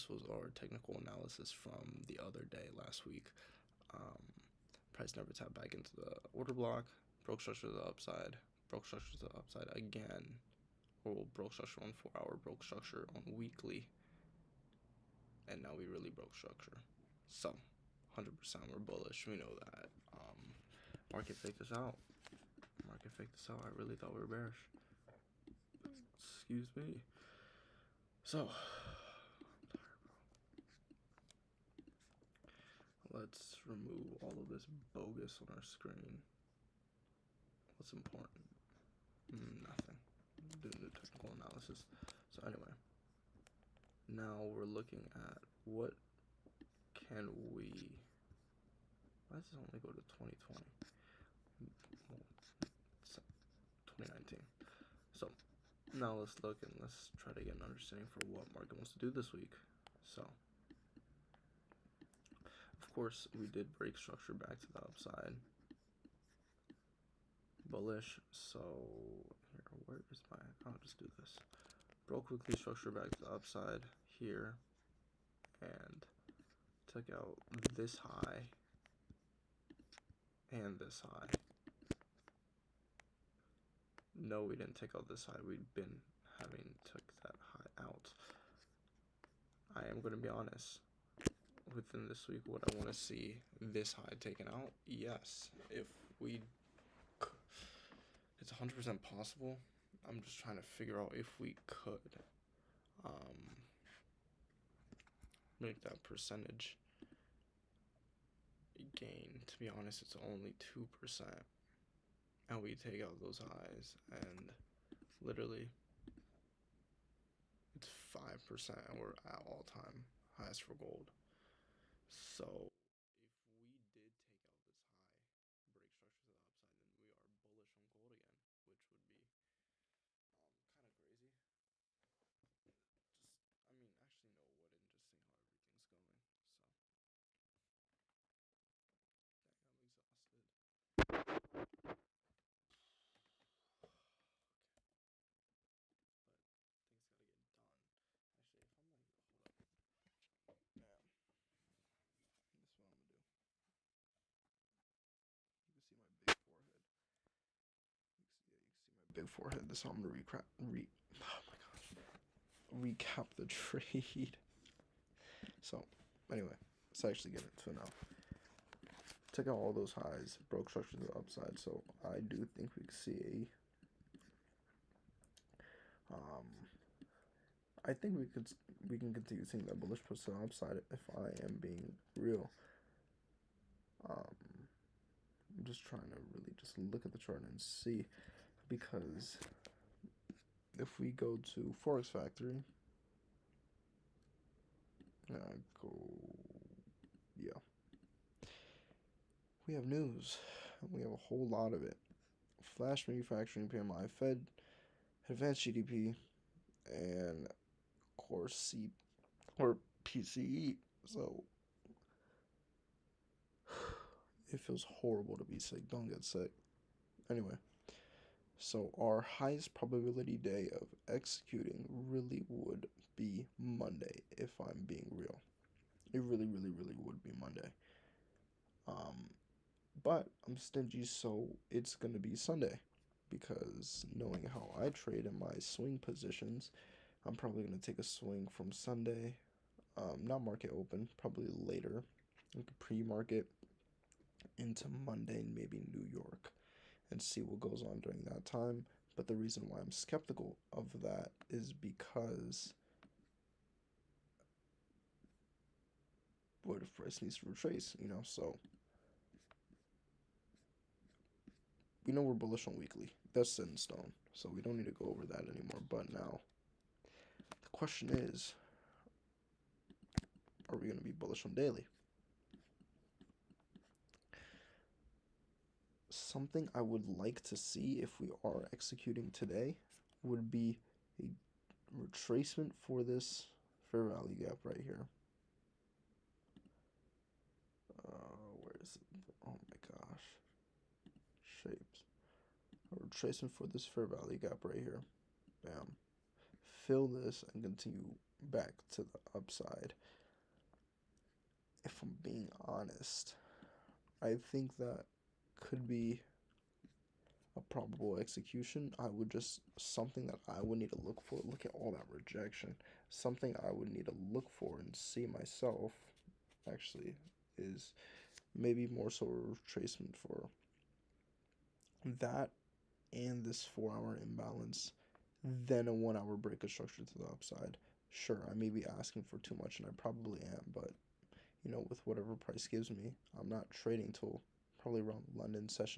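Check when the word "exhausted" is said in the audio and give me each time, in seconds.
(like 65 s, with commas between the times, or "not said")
139 s.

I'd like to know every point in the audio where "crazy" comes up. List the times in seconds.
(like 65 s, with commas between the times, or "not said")
130 s.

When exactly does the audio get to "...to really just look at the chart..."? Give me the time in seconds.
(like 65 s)
186 s.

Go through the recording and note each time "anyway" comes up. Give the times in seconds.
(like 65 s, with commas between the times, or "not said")
42 s, 166 s, 217 s.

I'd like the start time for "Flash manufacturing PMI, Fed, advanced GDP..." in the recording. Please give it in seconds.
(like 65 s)
202 s.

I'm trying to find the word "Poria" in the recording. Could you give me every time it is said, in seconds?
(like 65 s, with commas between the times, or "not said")
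not said.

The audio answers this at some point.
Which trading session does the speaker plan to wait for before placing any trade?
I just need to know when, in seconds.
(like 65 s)
335 s.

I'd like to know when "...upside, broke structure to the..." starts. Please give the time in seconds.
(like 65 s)
7 s.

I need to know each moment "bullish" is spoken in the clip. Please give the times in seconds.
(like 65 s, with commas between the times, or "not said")
18 s, 67 s, 127 s, 179 s, 262 s, 271 s.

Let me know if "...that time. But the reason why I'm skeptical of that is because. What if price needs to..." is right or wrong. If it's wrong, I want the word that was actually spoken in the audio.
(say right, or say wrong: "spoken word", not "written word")
right.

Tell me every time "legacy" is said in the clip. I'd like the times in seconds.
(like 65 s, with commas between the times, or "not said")
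not said.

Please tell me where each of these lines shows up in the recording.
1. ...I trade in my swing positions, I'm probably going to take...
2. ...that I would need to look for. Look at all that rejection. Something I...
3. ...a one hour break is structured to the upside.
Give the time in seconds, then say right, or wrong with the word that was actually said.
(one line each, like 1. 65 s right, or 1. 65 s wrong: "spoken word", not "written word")
1. 234 s right
2. 310 s right
3. 325 s right.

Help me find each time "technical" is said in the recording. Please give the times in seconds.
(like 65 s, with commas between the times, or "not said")
0 s, 40 s.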